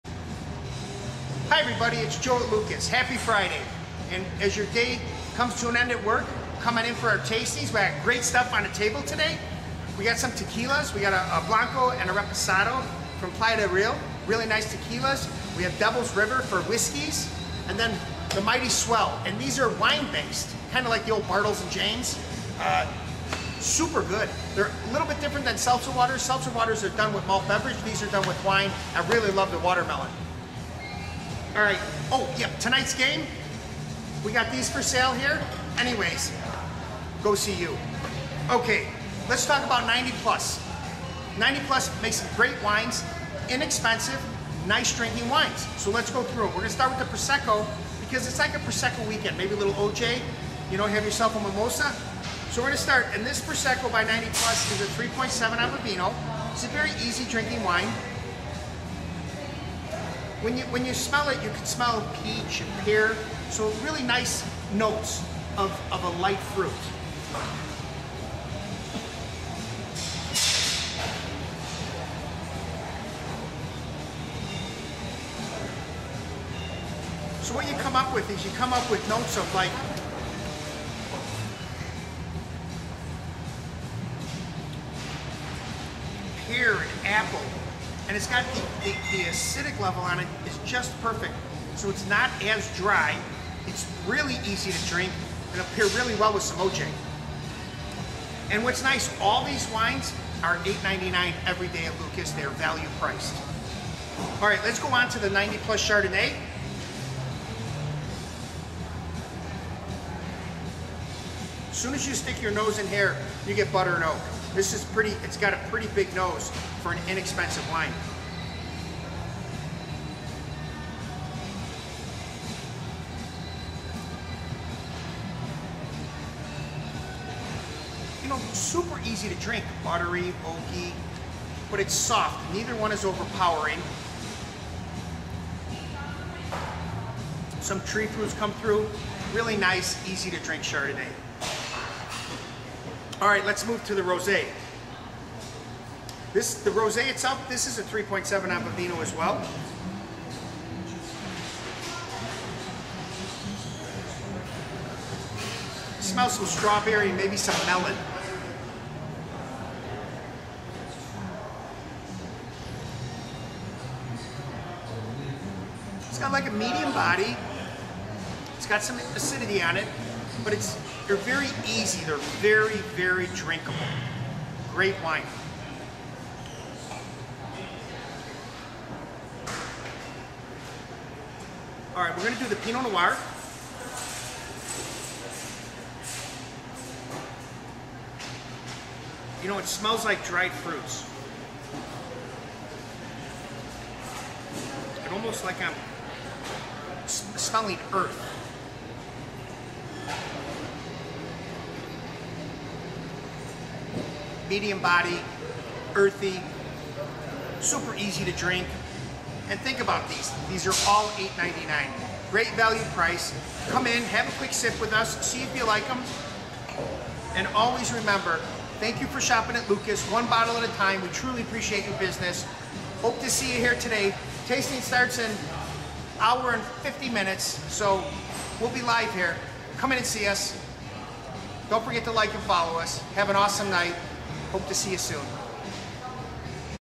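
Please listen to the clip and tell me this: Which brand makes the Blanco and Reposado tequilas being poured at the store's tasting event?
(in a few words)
Playa del Rio.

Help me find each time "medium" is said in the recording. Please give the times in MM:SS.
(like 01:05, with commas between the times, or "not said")
02:46, 03:24.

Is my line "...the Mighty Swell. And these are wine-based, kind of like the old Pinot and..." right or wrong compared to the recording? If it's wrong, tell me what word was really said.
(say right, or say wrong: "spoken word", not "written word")
wrong: "Bartles", not "Pinot".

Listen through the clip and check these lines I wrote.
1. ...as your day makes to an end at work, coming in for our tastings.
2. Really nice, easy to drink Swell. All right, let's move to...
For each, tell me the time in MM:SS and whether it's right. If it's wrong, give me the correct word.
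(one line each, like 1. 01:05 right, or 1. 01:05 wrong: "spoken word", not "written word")
1. 00:04 wrong: "comes", not "makes"
2. 02:19 wrong: "Chardonnay", not "Swell".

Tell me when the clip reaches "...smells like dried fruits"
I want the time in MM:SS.
03:09.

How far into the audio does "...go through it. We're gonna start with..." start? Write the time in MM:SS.
00:46.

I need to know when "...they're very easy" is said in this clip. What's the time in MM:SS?
02:51.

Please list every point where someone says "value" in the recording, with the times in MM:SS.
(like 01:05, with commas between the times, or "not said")
01:42, 03:32.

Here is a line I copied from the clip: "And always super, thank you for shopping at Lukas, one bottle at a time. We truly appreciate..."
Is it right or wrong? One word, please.
wrong.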